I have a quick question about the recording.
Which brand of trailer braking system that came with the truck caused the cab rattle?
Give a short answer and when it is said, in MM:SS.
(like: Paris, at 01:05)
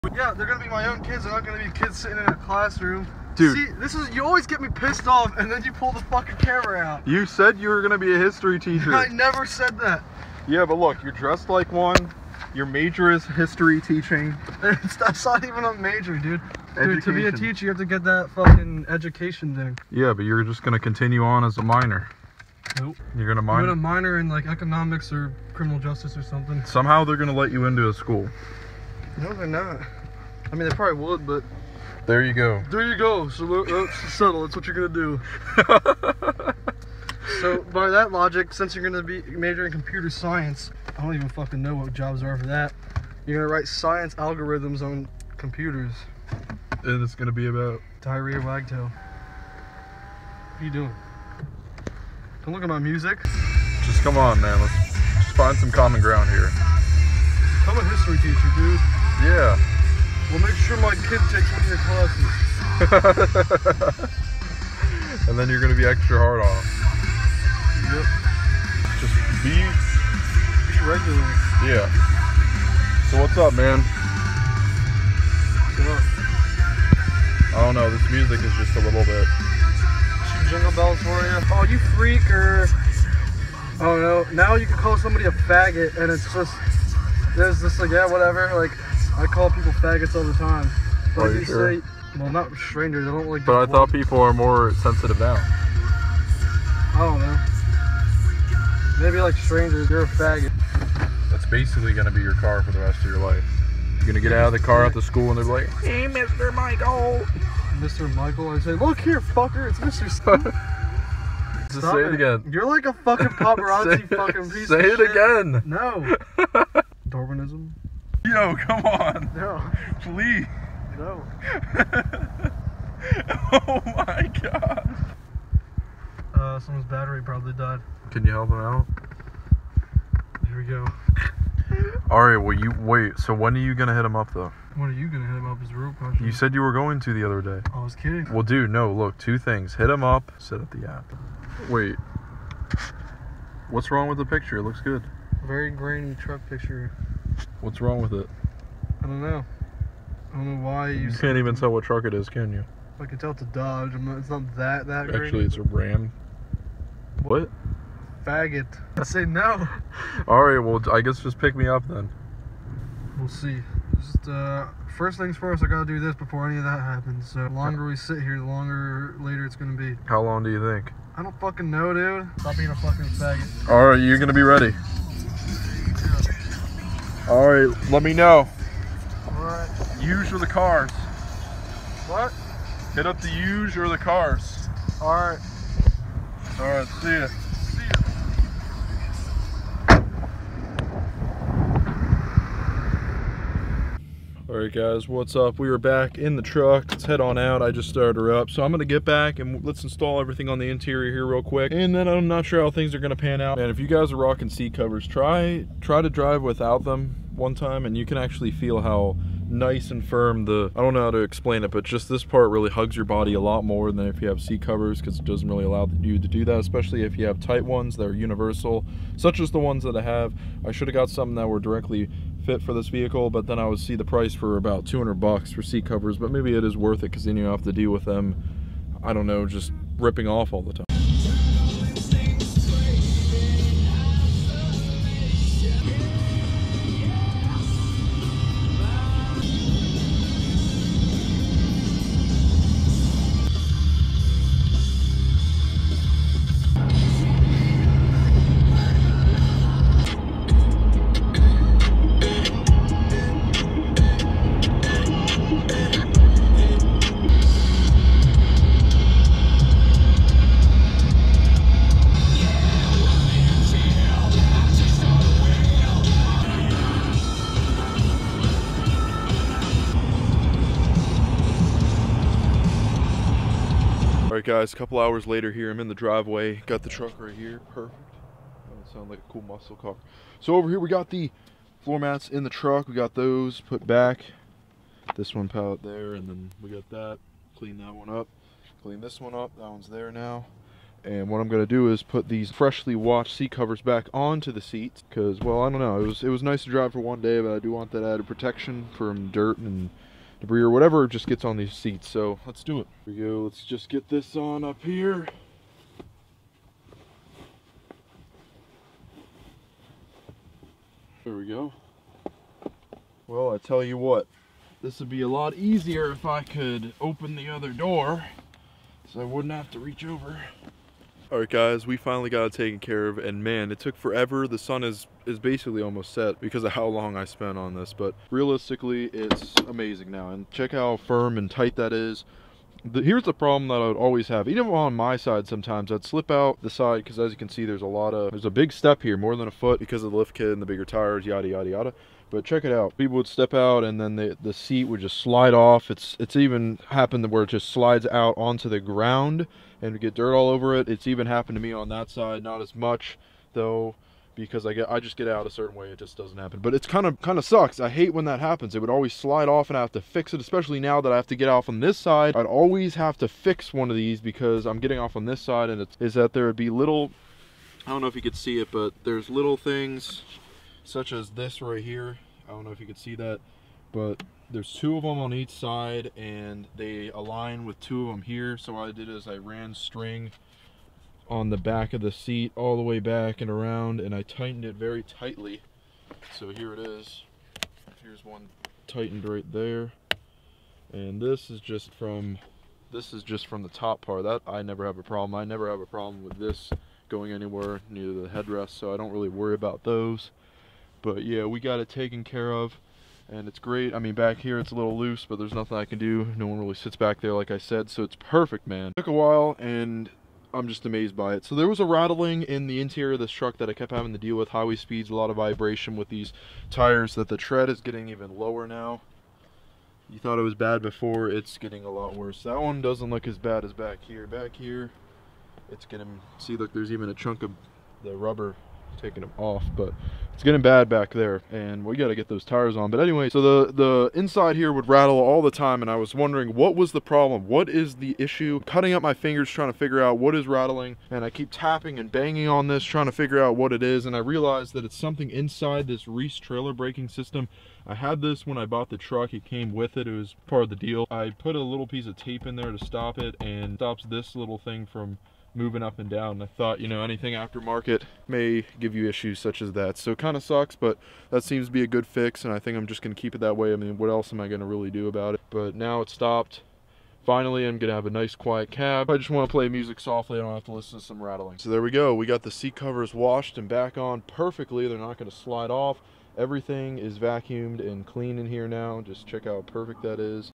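Reese, at 07:26.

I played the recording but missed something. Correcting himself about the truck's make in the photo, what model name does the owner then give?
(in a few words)
Ram.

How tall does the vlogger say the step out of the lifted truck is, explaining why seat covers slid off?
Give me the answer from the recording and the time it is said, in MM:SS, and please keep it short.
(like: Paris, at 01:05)
More than a foot, at 05:39.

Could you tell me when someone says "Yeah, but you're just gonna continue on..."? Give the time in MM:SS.
00:19.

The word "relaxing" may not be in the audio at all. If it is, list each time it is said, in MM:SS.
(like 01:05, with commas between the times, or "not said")
not said.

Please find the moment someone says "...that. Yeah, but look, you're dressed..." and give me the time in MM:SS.
00:09.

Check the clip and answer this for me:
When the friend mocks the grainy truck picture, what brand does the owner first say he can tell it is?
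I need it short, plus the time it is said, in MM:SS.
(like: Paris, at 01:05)
Dodge, at 02:33.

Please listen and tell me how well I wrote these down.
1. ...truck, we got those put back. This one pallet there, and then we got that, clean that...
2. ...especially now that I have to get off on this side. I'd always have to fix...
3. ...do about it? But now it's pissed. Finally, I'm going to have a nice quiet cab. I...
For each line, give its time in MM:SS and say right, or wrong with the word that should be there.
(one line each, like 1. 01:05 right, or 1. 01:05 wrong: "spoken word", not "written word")
1. 04:42 right
2. 06:00 right
3. 07:44 wrong: "stopped", not "pissed".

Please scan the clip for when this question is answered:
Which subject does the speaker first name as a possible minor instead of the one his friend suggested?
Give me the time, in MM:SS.
00:24.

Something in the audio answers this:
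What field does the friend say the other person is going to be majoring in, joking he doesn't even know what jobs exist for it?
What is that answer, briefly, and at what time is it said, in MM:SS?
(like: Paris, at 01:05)
Computer science, at 00:39.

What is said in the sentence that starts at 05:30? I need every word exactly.
And check how firm and tight that is.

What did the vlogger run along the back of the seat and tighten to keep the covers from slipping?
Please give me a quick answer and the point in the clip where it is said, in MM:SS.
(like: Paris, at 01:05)
String, at 06:19.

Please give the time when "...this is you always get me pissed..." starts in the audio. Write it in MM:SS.
00:03.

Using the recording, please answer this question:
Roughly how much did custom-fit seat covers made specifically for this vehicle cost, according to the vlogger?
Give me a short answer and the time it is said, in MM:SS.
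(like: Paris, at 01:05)
$200, at 03:44.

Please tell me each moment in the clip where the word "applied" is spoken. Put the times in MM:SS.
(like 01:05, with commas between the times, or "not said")
not said.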